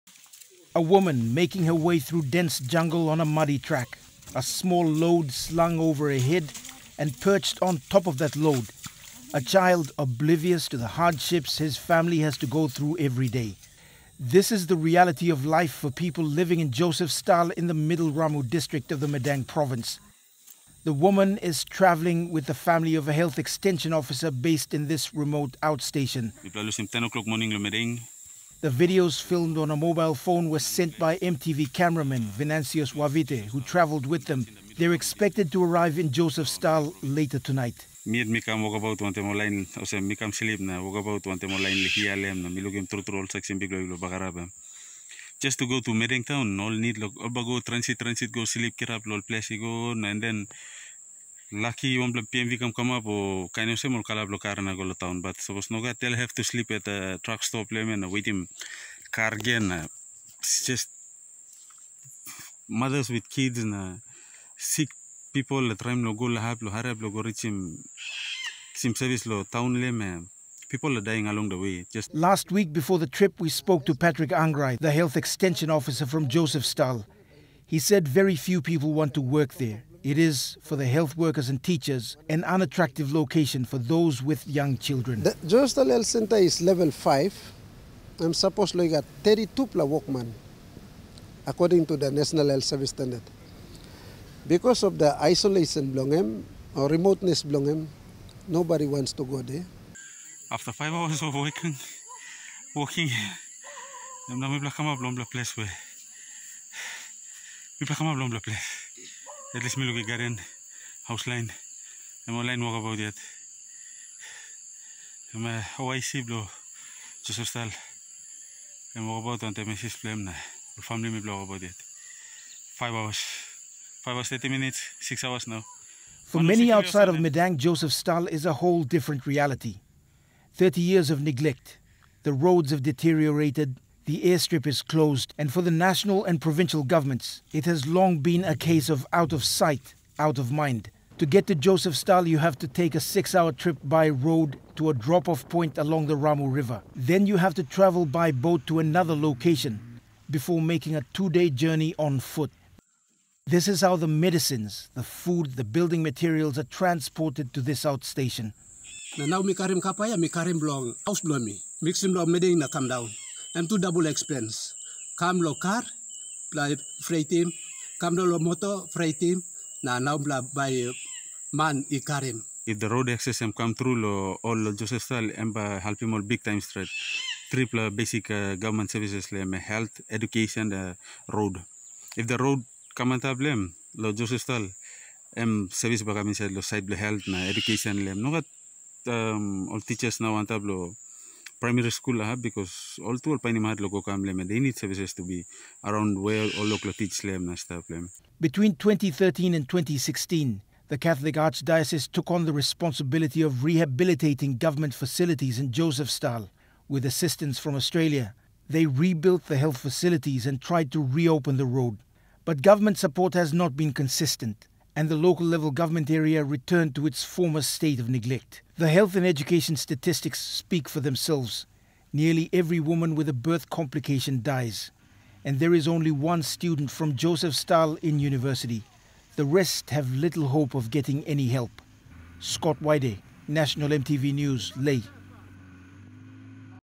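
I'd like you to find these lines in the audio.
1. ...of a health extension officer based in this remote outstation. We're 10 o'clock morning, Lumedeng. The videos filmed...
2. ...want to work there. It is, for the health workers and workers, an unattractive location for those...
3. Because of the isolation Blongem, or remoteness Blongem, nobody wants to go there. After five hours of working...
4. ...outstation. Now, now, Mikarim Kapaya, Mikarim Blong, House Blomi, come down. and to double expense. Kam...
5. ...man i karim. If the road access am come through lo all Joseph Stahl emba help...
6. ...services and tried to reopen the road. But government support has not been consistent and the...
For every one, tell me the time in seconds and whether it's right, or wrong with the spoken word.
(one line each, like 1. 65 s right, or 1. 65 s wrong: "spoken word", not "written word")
1. 22 s right
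2. 78 s wrong: "teachers", not "workers"
3. 94 s right
4. 157 s right
5. 171 s right
6. 209 s wrong: "facilities", not "services".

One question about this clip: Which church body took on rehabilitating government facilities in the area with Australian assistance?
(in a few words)
Catholic Archdiocese.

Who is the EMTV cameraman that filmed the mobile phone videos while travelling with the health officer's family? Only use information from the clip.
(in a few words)
Vinansius Wavite.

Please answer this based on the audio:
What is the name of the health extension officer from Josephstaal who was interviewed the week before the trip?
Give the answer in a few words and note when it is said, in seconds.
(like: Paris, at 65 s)
Patrick Angrai, at 73 s.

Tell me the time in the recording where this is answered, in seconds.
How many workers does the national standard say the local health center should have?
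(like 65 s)
89 s.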